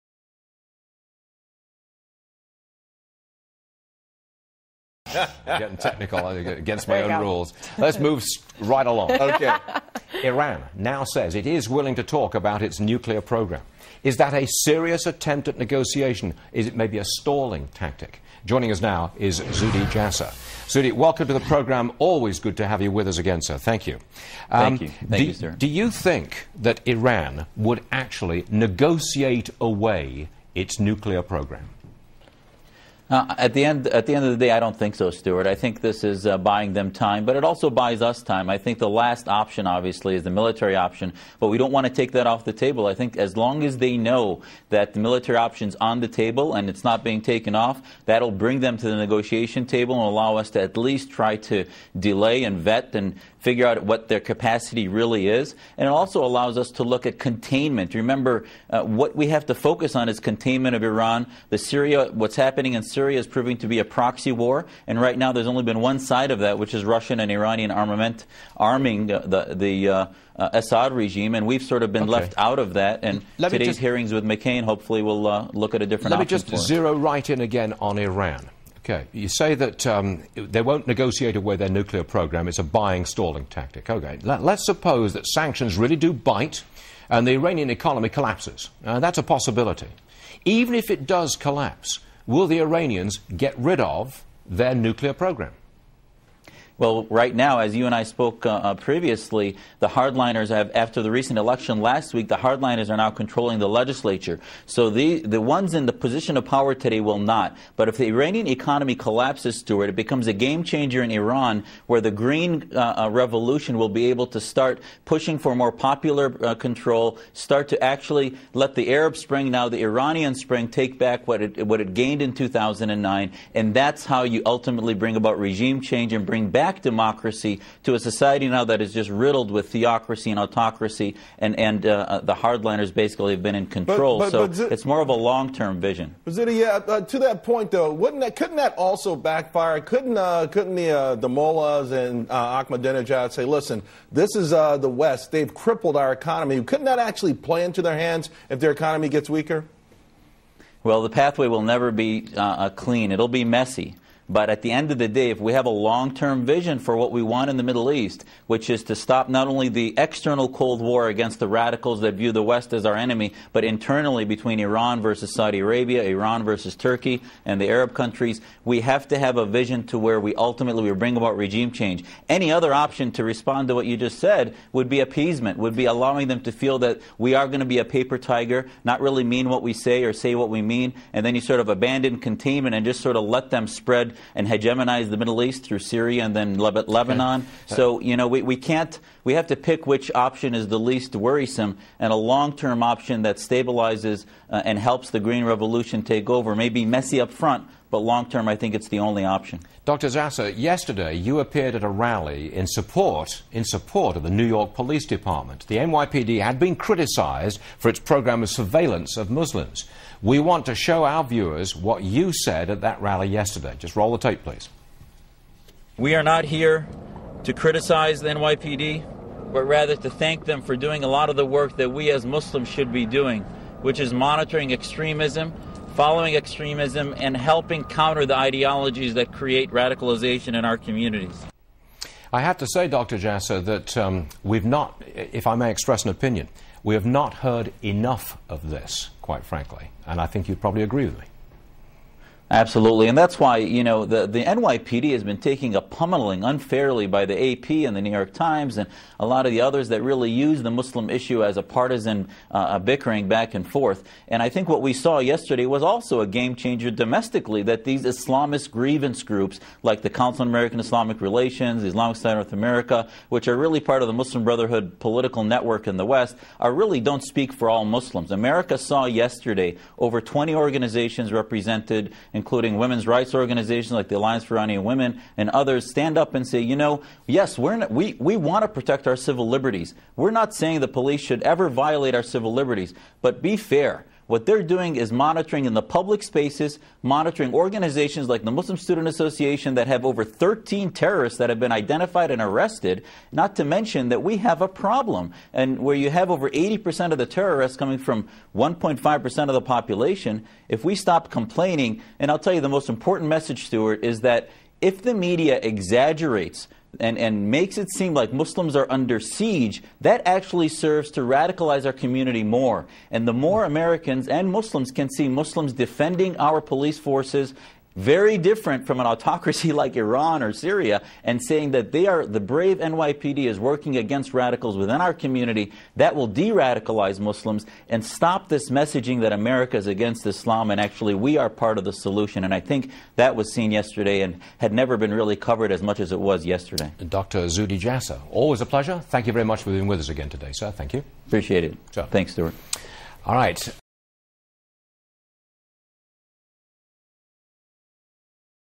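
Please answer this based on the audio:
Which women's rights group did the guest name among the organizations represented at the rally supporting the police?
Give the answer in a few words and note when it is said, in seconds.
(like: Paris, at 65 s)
Alliance for Iranian Women, at 274 s.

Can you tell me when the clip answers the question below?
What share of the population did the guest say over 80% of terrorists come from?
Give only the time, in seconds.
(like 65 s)
298 s.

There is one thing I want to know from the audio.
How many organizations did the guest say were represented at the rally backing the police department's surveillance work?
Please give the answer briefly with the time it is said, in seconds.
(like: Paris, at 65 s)
over 20, at 269 s.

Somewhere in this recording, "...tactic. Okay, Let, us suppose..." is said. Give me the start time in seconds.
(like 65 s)
83 s.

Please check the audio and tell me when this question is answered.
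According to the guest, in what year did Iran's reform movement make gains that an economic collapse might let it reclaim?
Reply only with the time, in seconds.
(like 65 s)
122 s.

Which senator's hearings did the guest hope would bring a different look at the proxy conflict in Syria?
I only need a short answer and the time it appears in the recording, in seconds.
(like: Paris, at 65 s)
McCain, at 74 s.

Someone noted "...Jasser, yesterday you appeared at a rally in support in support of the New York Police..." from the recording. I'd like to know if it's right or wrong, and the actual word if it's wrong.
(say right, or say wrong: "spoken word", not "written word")
right.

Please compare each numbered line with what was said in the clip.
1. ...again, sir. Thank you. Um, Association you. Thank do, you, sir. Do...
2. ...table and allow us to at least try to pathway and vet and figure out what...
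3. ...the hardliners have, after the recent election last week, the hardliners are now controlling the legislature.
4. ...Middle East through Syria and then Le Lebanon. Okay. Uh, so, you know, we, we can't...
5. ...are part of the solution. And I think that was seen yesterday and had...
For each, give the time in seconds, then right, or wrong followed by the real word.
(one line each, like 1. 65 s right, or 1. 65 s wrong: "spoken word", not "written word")
1. 23 s wrong: "Thank", not "Association"
2. 49 s wrong: "delay", not "pathway"
3. 99 s right
4. 185 s right
5. 331 s right.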